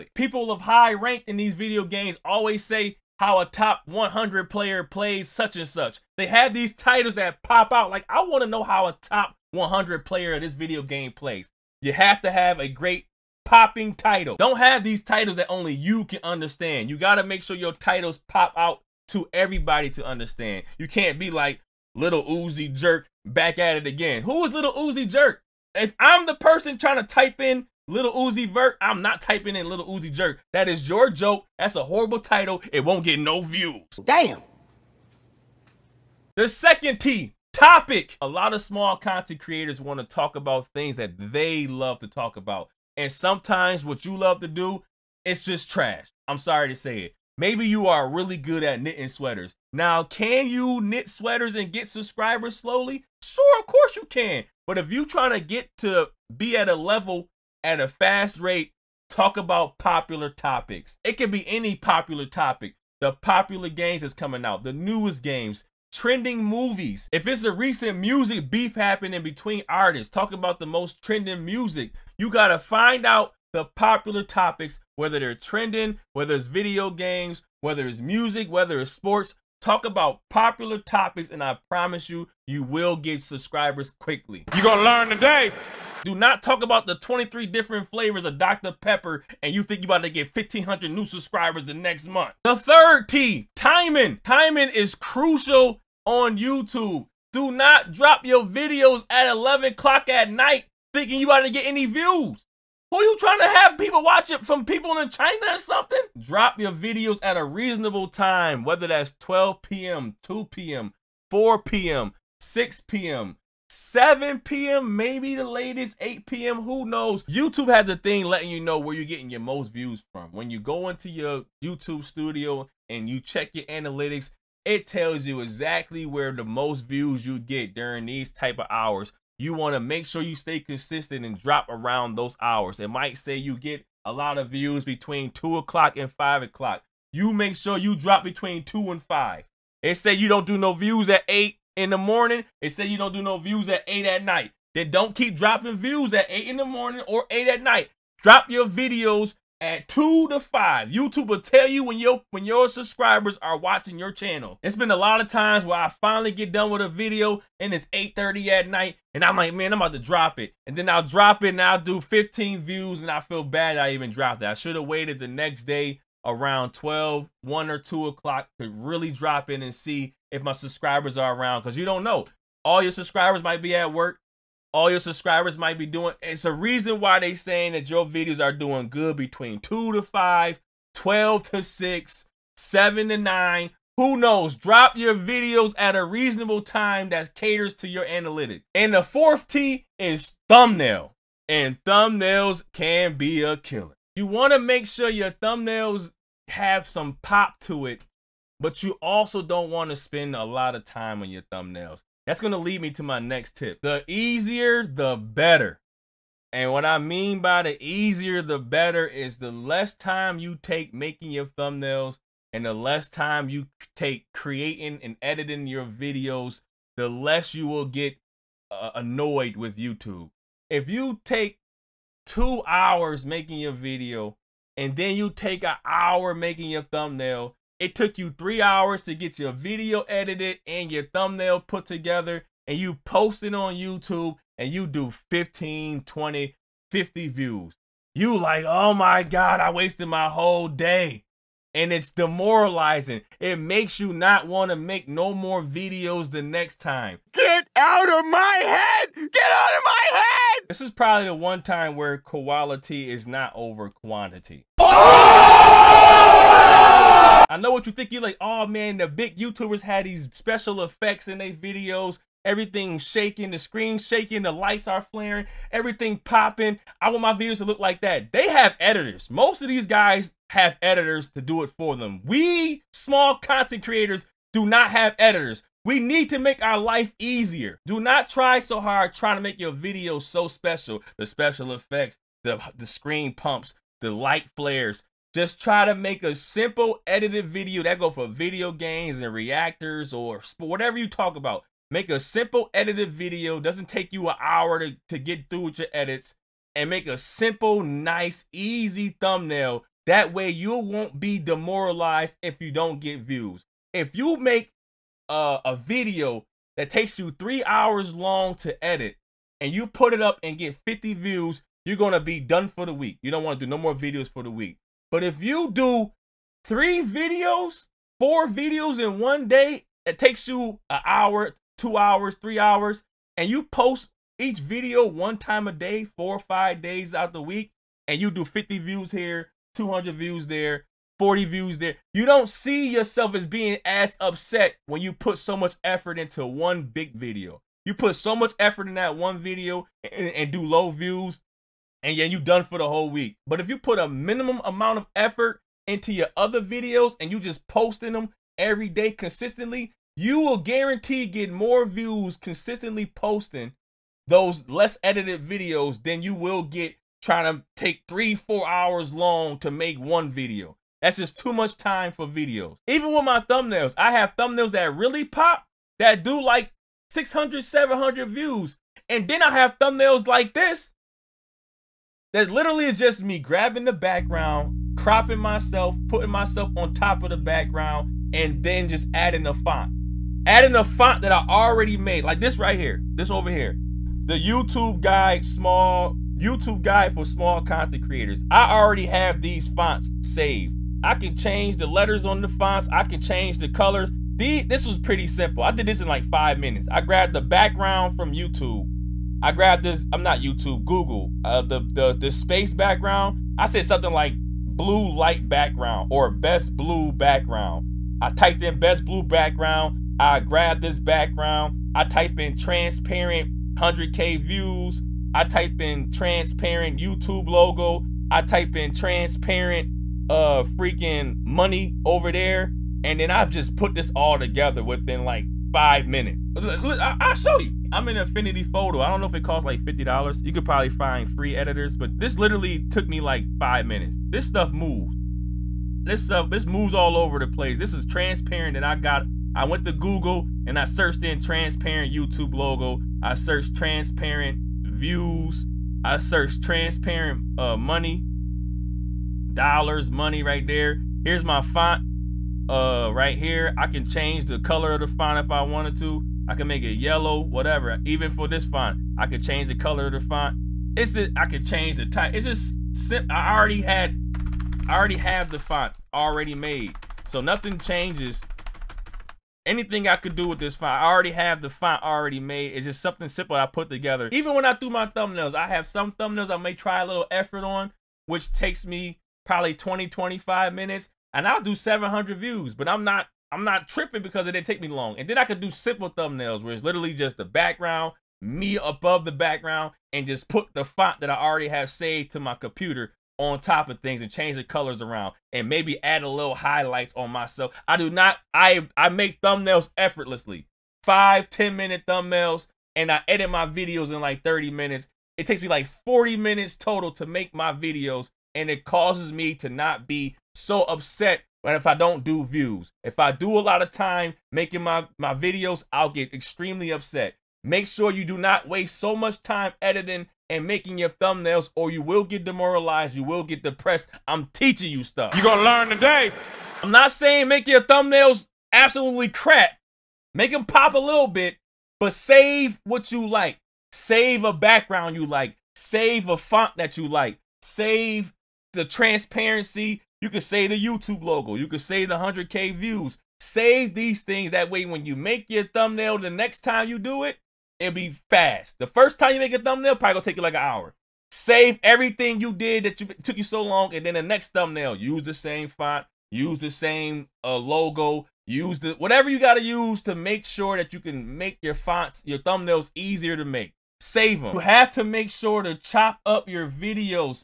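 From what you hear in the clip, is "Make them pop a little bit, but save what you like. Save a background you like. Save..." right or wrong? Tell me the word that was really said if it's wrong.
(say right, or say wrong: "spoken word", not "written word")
right.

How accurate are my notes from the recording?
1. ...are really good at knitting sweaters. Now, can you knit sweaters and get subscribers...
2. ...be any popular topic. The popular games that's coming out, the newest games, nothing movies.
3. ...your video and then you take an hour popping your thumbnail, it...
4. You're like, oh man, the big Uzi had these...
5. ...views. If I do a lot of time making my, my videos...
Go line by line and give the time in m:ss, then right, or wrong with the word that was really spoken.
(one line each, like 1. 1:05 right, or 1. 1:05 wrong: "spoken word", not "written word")
1. 0:47 right
2. 1:01 wrong: "trending", not "nothing"
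3. 3:43 wrong: "making", not "popping"
4. 4:18 wrong: "YouTubers", not "Uzi"
5. 8:32 right.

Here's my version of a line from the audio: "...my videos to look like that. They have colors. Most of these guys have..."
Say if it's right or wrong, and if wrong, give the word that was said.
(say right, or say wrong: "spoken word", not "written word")
wrong: "editors", not "colors".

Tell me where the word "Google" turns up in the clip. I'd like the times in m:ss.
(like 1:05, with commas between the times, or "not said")
6:40, 7:19.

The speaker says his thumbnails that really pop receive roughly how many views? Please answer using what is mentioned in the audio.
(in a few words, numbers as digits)
600, 700.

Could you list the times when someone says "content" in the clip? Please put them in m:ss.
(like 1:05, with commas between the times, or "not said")
0:38, 4:33, 6:27.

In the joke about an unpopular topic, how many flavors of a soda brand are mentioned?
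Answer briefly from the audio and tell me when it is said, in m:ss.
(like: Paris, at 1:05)
23, at 1:26.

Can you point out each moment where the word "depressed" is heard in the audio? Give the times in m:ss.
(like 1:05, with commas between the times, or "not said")
8:43.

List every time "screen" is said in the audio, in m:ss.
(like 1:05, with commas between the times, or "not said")
4:23, 4:42.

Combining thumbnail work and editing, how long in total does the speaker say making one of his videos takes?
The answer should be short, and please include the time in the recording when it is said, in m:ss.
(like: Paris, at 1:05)
40 minutes, at 8:26.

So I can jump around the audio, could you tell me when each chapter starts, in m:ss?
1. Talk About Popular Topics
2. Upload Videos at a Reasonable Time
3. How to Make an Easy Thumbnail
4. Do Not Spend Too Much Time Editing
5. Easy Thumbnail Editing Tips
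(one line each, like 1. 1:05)
1. 0:36
2. 1:32
3. 3:08
4. 4:17
5. 6:02.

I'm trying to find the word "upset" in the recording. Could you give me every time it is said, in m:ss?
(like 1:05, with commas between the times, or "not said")
5:34, 8:30, 8:36.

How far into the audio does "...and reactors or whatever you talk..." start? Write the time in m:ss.
4:49.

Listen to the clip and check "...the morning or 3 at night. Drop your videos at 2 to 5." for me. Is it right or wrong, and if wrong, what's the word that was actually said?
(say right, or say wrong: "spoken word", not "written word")
wrong: "8", not "3".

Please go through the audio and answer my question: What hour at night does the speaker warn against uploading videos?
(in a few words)
11 o'clock.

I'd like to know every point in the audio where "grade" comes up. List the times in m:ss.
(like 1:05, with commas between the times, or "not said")
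not said.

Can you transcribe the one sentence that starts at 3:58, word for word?
You like, oh my God, I wasted my whole day.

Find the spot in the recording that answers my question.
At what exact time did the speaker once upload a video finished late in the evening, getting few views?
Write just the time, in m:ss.
2:37.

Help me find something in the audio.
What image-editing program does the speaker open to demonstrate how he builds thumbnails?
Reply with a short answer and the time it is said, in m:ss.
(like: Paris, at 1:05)
Affinity Photo, at 7:08.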